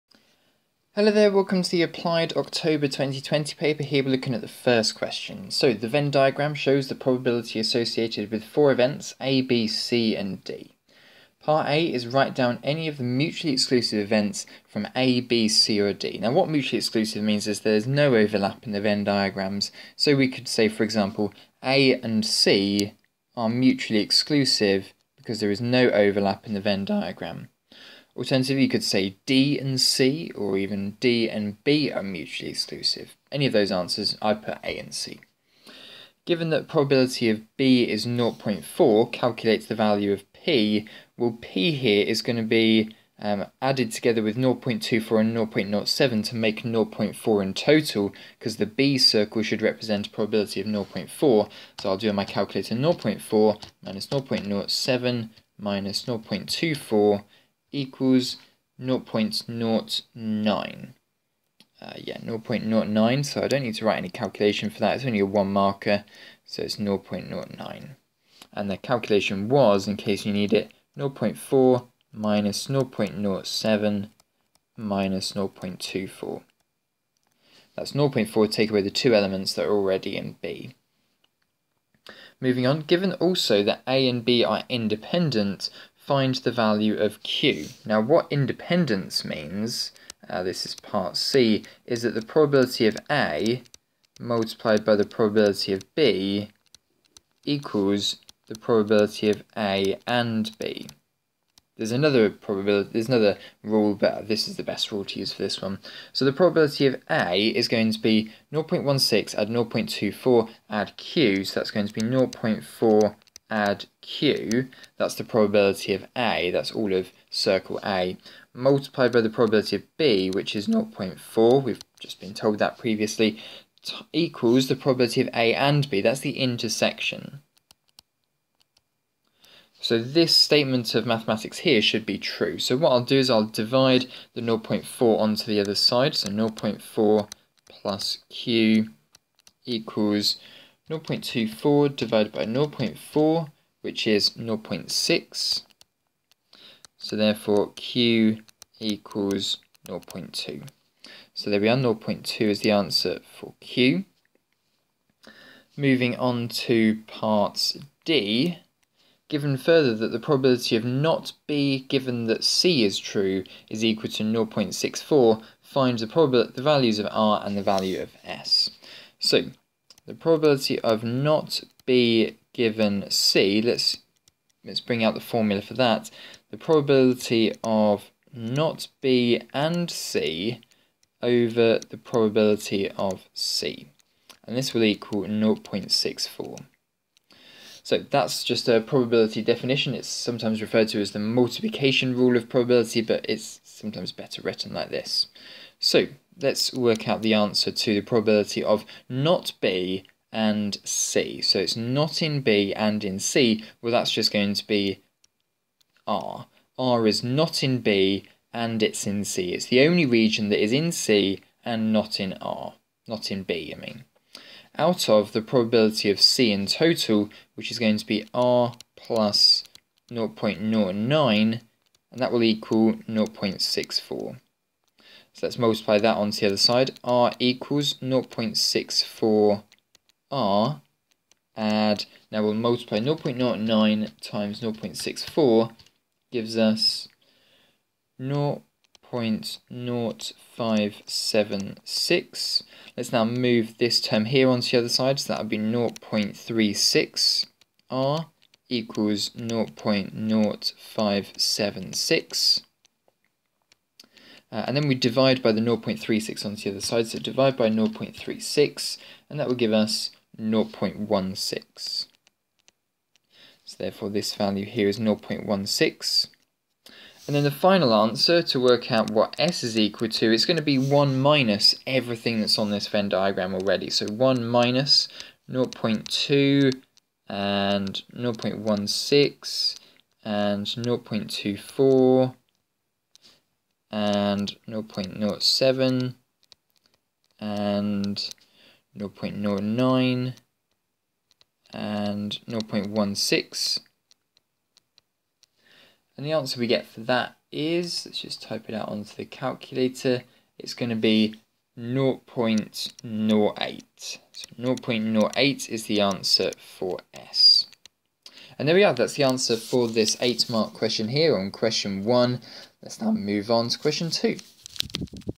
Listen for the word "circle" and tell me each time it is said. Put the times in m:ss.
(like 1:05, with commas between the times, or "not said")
0:48, 1:57.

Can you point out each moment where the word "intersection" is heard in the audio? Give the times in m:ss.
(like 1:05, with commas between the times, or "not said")
2:06.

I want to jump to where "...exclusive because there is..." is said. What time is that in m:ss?
0:24.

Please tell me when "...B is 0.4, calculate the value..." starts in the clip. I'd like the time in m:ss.
0:37.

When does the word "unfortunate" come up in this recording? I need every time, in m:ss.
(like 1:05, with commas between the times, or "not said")
not said.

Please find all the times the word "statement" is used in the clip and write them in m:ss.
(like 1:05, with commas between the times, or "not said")
2:10.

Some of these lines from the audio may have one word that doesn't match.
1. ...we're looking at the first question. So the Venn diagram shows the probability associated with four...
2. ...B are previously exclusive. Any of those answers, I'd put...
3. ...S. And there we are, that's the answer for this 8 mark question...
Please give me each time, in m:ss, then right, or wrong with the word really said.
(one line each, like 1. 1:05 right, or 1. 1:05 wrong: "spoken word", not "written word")
1. 0:04 right
2. 0:31 wrong: "mutually", not "previously"
3. 5:07 right.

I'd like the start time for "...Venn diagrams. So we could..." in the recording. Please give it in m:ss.
0:18.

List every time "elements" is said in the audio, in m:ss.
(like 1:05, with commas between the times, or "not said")
1:19.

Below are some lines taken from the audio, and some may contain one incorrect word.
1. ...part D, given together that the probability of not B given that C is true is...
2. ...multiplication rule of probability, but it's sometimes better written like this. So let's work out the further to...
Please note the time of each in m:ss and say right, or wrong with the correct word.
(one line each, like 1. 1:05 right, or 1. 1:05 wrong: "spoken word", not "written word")
1. 2:37 wrong: "further", not "together"
2. 3:11 wrong: "answer", not "further".